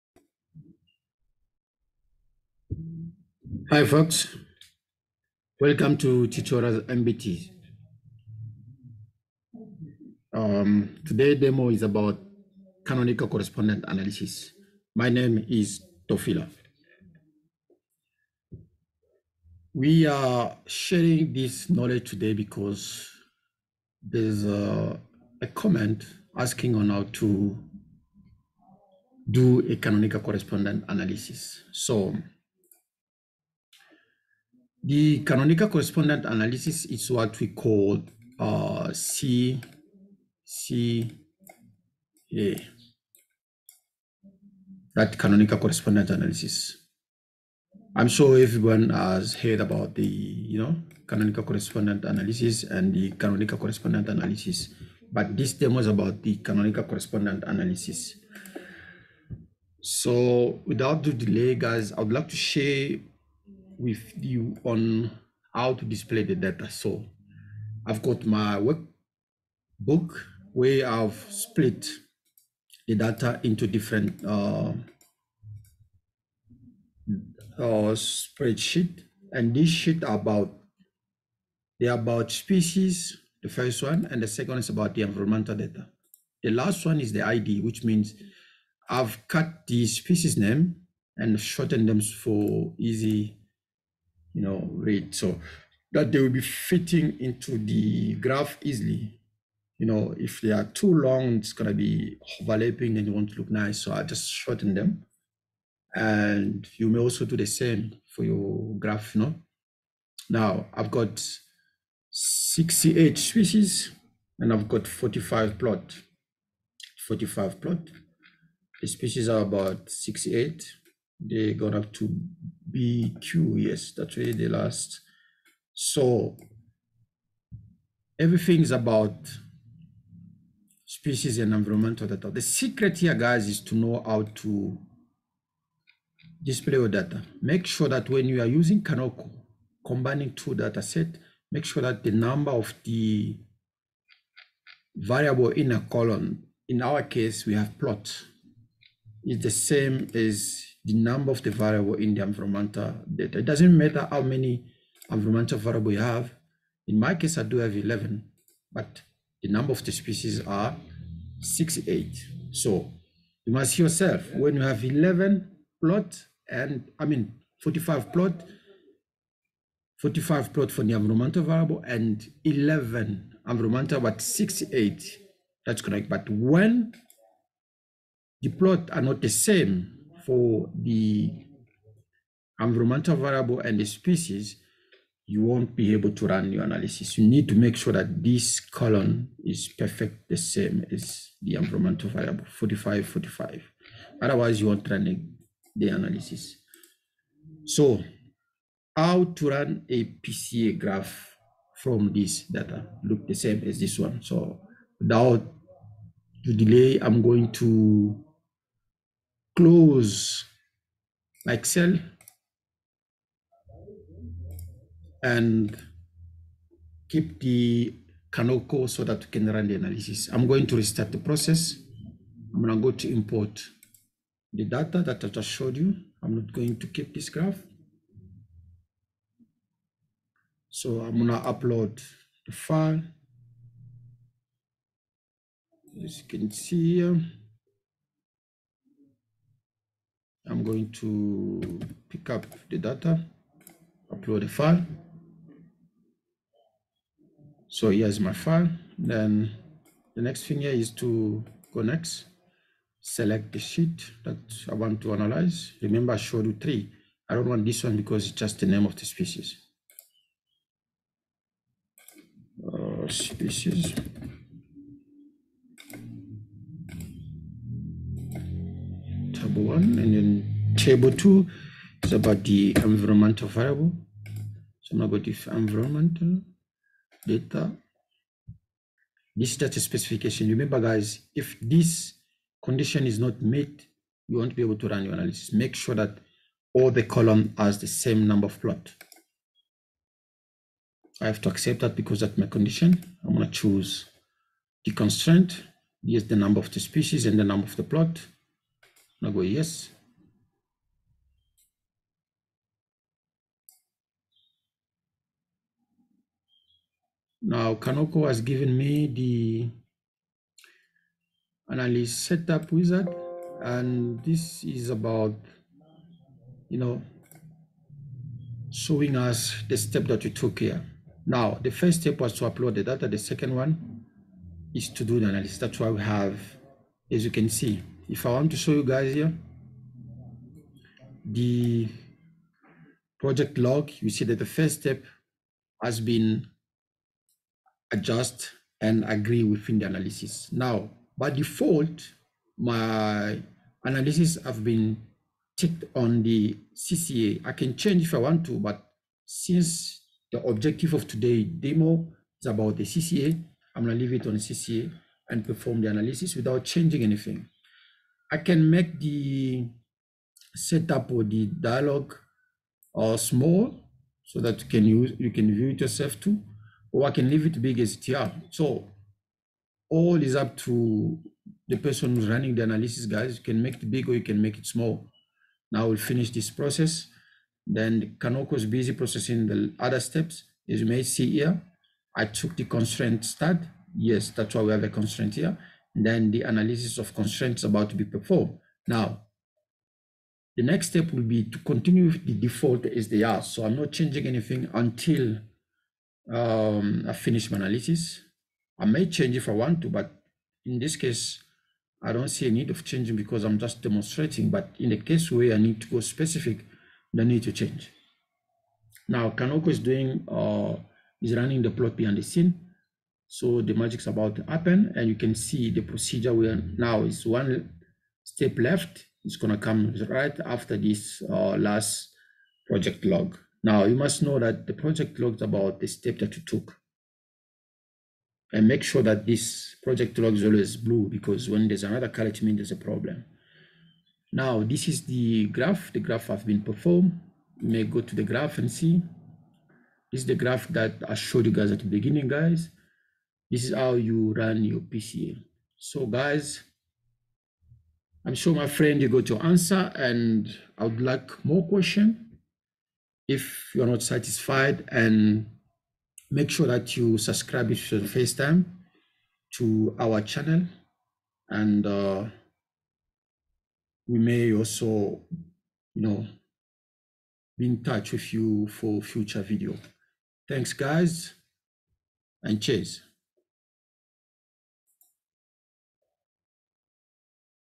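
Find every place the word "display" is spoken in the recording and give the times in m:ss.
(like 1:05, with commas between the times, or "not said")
1:05, 2:16.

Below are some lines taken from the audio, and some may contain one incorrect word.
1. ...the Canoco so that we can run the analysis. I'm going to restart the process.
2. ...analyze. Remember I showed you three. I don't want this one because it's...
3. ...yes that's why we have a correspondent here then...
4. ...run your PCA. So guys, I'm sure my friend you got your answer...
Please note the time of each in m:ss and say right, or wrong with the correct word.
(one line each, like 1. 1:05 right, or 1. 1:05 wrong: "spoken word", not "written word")
1. 3:37 right
2. 4:15 right
3. 6:23 wrong: "constraint", not "correspondent"
4. 7:24 right.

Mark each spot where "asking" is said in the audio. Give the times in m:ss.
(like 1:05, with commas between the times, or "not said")
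0:26.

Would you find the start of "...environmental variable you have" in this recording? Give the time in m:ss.
2:35.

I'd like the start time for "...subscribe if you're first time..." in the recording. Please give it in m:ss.
7:37.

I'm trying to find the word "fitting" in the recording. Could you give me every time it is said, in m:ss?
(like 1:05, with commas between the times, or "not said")
1:36.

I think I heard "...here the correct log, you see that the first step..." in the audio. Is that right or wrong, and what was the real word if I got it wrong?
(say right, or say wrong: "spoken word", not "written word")
wrong: "project", not "correct".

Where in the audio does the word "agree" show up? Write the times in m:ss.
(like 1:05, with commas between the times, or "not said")
5:39.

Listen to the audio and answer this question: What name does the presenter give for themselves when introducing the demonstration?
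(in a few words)
Tofila.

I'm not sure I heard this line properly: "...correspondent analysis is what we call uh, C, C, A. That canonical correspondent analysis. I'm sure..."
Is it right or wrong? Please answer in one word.
right.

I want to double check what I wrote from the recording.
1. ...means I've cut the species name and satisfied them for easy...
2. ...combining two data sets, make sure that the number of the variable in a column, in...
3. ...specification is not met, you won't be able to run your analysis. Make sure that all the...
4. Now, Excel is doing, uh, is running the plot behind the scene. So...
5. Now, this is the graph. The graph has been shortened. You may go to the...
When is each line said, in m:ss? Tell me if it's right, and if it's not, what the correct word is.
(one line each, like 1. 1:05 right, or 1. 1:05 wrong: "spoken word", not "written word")
1. 1:27 wrong: "shortened", not "satisfied"
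2. 2:19 right
3. 4:42 wrong: "condition", not "specification"
4. 6:49 wrong: "Canoco", not "Excel"
5. 7:14 wrong: "performed", not "shortened".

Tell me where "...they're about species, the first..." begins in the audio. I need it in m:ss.
1:21.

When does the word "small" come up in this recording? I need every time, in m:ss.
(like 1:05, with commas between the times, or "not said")
6:03, 6:14.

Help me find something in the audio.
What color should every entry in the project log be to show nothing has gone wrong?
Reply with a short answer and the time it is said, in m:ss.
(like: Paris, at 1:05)
Blue, at 7:10.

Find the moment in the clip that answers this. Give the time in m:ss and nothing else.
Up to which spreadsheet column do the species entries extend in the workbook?
2:02.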